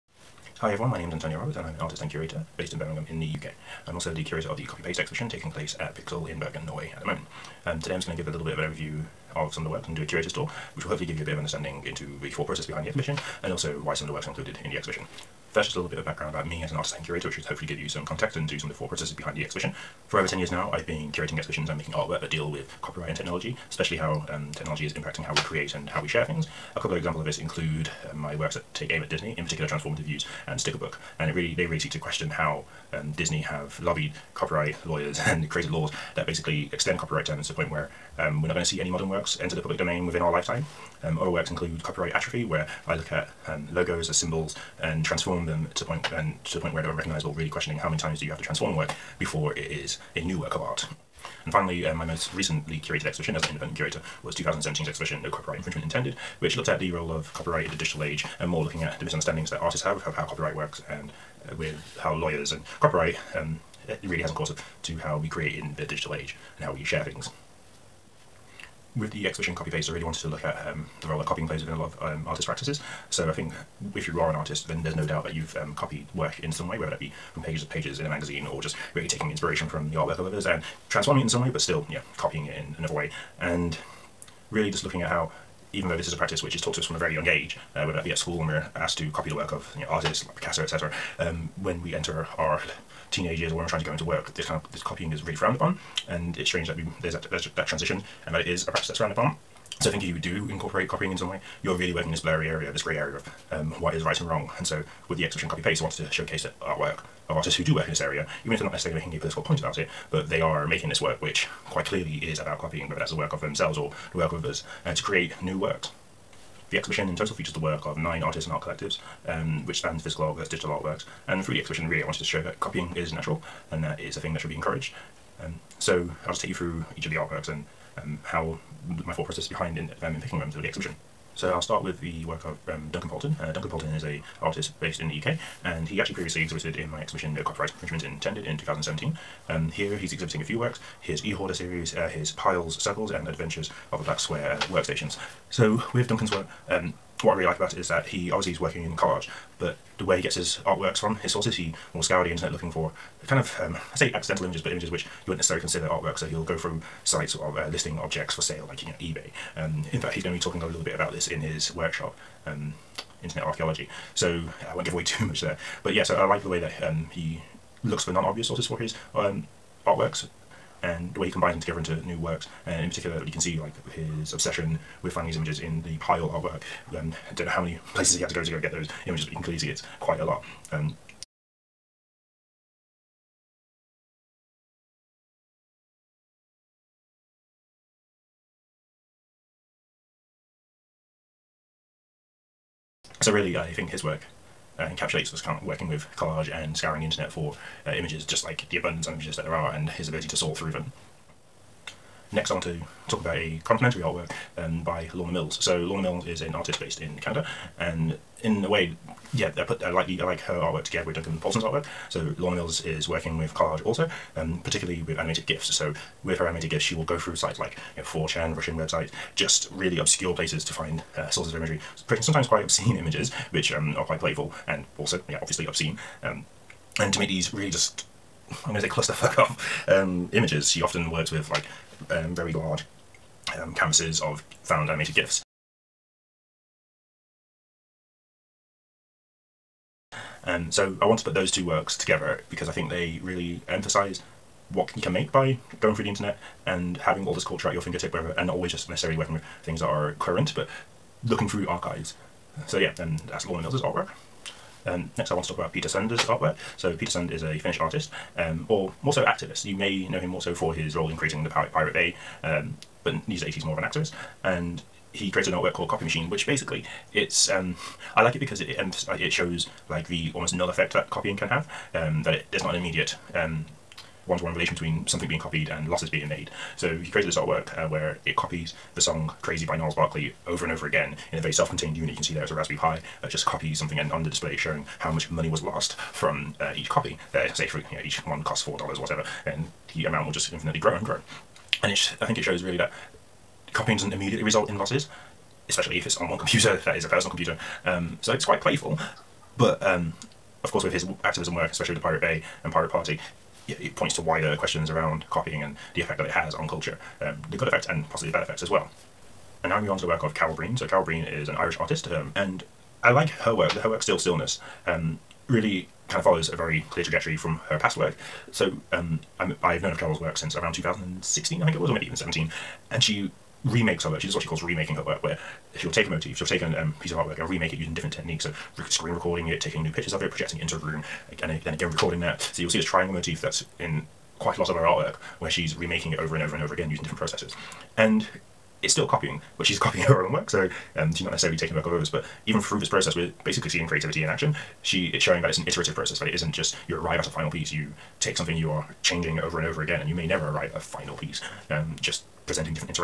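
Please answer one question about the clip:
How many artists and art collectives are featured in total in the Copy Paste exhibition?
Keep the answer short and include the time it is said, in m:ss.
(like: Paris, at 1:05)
9, at 1:57.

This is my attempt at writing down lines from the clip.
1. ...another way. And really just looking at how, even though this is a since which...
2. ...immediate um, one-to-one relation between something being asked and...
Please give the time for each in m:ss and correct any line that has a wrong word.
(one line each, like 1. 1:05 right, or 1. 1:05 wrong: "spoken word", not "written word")
1. 1:22 wrong: "practice", not "since"
2. 4:32 wrong: "copied", not "asked".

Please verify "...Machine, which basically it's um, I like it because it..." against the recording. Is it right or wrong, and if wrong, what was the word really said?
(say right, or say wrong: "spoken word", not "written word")
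right.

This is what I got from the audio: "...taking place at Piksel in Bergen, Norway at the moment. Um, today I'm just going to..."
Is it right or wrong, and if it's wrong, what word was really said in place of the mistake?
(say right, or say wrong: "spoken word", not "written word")
right.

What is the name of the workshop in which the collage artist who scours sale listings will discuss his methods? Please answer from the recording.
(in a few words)
Internet Archaeology.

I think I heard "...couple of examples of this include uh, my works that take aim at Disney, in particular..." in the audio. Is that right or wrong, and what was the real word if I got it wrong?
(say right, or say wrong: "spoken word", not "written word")
right.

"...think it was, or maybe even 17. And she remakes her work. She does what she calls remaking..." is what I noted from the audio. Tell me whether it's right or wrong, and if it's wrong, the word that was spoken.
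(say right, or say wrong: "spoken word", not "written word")
right.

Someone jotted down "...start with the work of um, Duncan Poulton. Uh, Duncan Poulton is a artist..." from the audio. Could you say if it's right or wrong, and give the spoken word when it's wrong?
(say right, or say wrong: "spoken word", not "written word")
right.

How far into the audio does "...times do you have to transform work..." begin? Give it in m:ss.
0:47.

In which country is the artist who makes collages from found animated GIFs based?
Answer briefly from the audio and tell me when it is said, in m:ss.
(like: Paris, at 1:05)
Canada, at 3:27.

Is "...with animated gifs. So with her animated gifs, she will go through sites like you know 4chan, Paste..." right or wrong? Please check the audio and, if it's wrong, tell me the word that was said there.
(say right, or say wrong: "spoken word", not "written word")
wrong: "Russian", not "Paste".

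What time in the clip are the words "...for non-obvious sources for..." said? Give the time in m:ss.
2:48.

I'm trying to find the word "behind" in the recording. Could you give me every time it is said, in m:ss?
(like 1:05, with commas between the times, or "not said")
0:12, 0:19, 2:09.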